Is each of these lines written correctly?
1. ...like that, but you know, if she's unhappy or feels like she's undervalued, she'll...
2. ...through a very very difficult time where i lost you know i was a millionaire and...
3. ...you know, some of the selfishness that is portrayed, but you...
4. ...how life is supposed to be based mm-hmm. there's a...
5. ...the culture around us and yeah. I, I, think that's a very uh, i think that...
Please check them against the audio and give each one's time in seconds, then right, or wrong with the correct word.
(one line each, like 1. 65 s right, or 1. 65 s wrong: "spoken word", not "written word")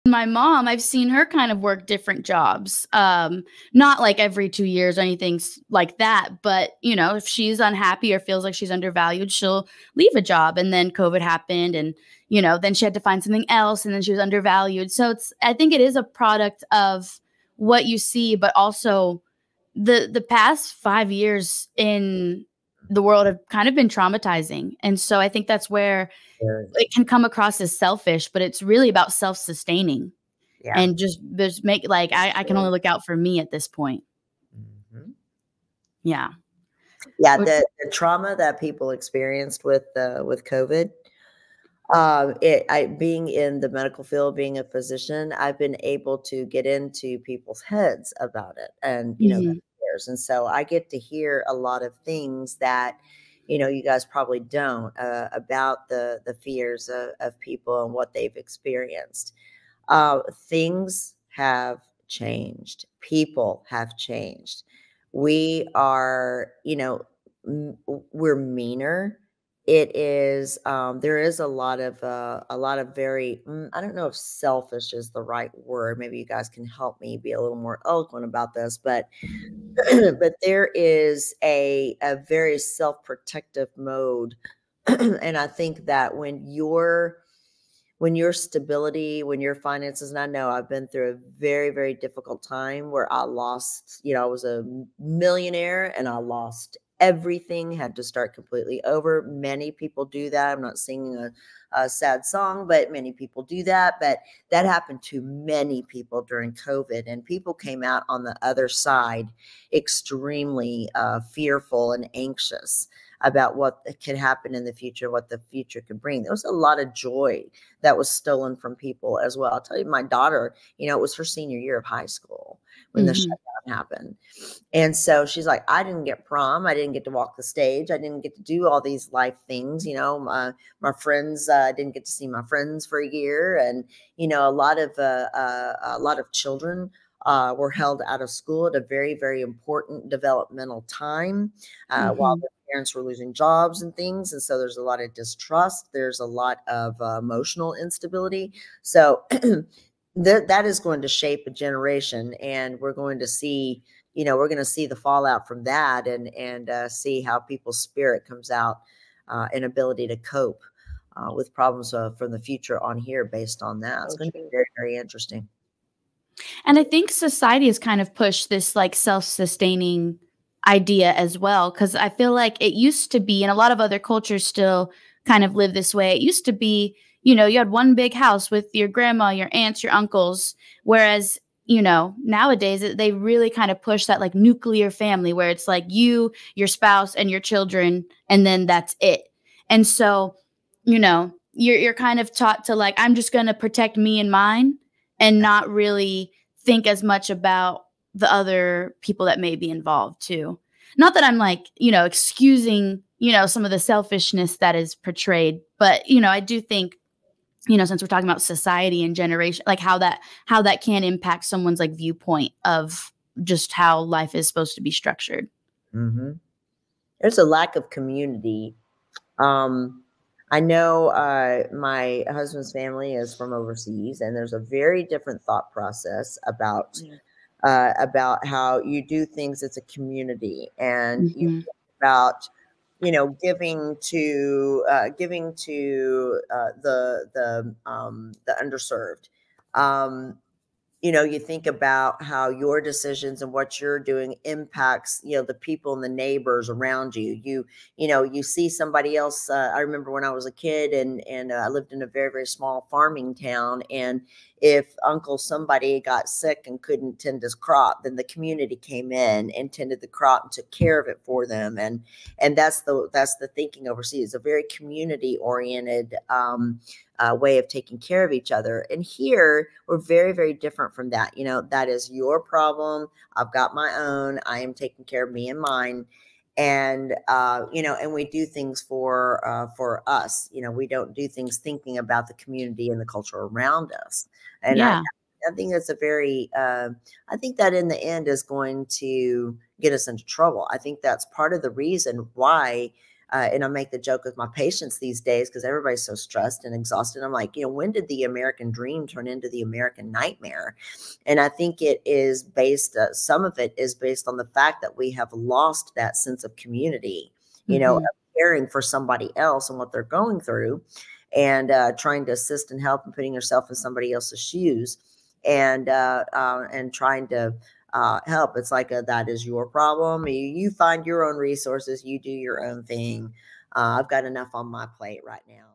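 1. 5 s right
2. 90 s right
3. 203 s right
4. 213 s wrong: "structured", not "based"
5. 282 s right.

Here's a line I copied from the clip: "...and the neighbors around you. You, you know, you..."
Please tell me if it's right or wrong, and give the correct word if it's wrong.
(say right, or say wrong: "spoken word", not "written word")
right.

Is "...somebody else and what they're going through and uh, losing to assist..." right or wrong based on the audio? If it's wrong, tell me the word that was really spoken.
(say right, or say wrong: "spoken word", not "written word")
wrong: "trying", not "losing".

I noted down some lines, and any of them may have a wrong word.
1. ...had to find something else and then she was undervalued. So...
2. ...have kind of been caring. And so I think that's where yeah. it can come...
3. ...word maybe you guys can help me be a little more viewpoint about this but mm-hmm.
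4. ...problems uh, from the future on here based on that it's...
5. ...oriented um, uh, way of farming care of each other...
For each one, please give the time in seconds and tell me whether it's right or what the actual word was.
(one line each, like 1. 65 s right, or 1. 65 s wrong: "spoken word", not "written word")
1. 12 s right
2. 23 s wrong: "traumatizing", not "caring"
3. 75 s wrong: "eloquent", not "viewpoint"
4. 161 s right
5. 265 s wrong: "taking", not "farming".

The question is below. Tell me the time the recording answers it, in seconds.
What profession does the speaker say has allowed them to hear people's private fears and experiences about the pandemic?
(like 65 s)
44 s.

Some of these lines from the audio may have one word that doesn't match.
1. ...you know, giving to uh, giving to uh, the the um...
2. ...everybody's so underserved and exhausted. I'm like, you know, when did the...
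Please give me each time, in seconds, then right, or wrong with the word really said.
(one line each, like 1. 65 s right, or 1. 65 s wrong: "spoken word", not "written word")
1. 233 s right
2. 295 s wrong: "stressed", not "underserved".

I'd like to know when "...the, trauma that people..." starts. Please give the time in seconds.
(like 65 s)
37 s.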